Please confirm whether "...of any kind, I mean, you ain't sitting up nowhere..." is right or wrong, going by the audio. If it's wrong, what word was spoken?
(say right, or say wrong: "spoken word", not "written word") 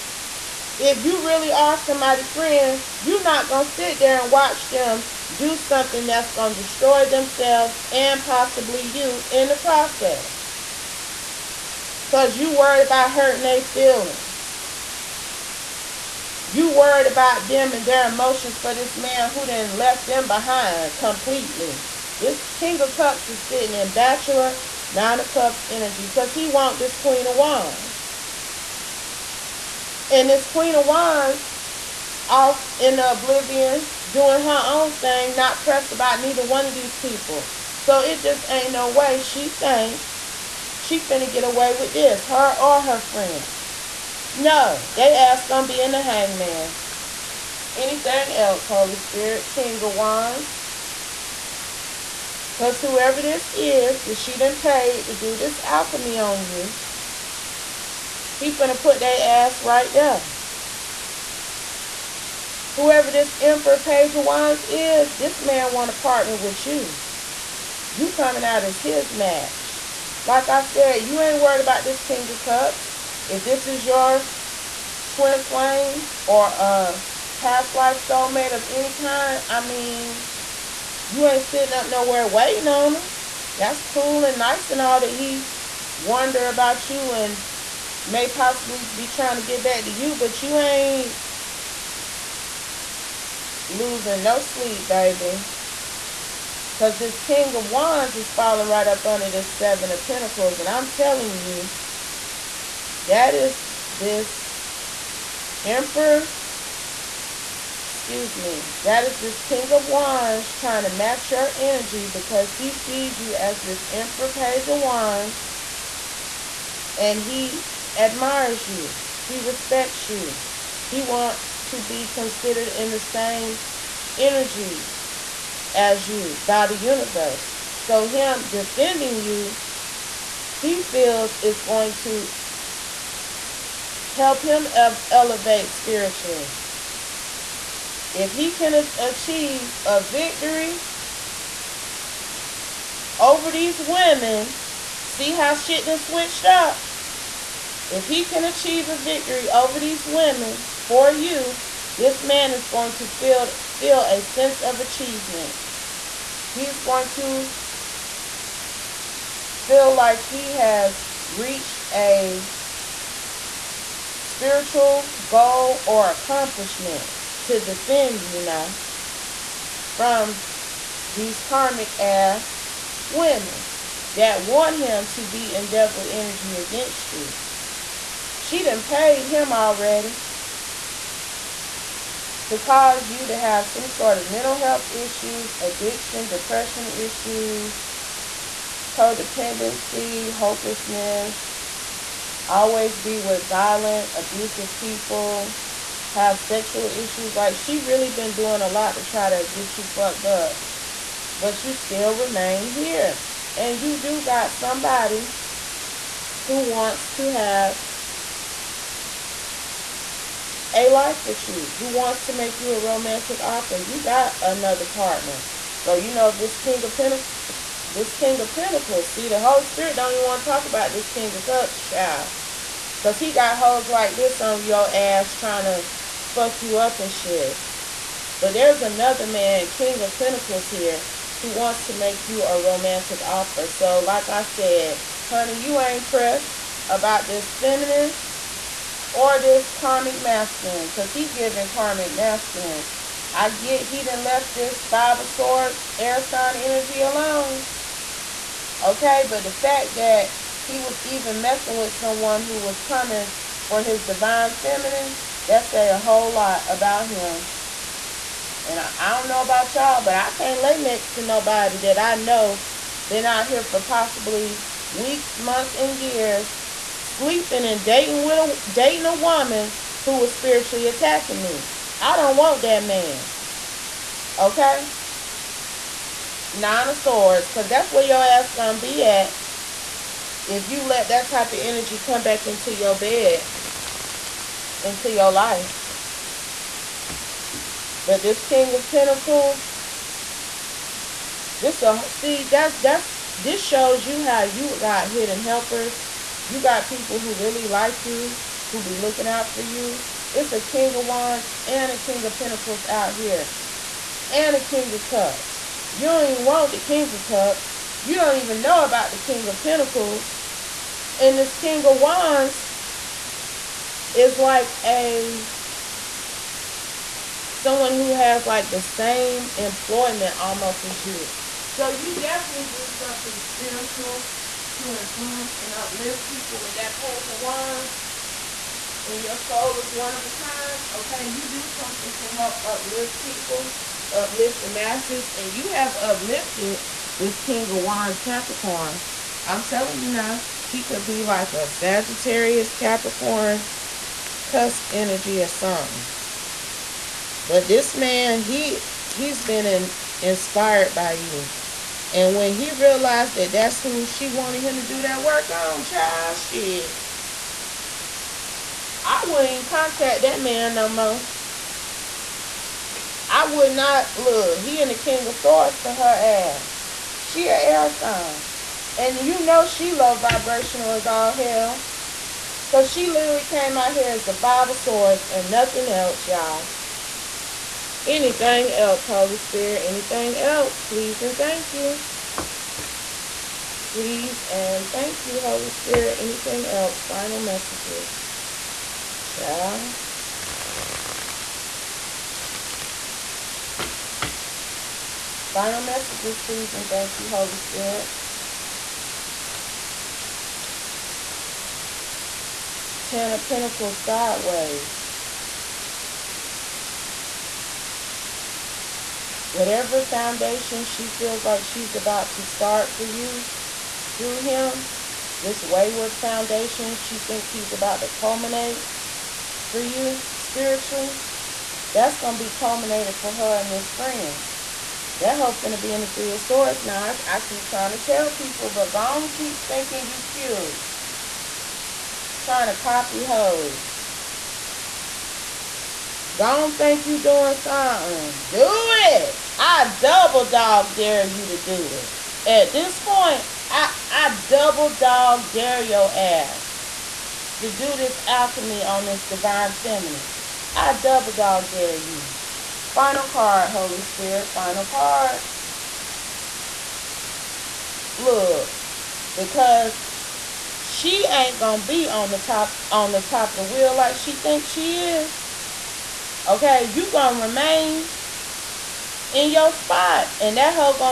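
right.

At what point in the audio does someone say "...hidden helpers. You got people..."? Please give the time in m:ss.
4:55.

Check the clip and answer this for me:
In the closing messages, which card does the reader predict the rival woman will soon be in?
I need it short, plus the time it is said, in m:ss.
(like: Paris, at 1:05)
Three of Swords, at 7:06.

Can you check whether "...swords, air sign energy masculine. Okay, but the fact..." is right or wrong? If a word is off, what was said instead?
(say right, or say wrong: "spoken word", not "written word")
wrong: "alone", not "masculine".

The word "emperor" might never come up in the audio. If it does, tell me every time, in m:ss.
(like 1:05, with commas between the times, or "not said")
1:03, 1:45, 1:53.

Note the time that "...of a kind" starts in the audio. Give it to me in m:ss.
5:30.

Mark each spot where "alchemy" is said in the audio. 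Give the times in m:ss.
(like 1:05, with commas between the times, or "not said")
0:55, 7:28.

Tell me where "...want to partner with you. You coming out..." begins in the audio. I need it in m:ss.
1:05.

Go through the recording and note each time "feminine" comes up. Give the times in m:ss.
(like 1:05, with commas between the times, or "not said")
3:57, 4:14, 7:29.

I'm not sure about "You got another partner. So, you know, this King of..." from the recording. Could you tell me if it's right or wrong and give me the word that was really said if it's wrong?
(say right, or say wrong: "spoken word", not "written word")
right.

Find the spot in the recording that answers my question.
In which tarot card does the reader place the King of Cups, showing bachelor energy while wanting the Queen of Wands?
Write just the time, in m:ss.
0:24.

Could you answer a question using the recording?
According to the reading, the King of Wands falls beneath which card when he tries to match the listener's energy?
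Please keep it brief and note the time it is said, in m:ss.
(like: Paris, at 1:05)
Seven of Pentacles, at 1:39.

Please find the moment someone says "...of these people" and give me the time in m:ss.
0:36.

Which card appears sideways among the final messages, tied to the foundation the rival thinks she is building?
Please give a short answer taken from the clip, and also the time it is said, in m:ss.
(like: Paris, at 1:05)
Ten of Pentacles, at 6:43.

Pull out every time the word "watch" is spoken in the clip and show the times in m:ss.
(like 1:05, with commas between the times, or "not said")
0:04.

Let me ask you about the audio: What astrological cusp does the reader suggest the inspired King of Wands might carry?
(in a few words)
Sagittarius Capricorn cusp.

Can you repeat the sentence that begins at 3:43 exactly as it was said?
Because he got hoes like this on your ass trying to fuck you up and shit.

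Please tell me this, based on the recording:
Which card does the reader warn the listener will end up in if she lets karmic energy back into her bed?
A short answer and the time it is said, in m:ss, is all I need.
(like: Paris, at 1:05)
Nine of swords, at 4:36.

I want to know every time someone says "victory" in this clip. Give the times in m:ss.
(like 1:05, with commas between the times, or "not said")
2:20, 2:28.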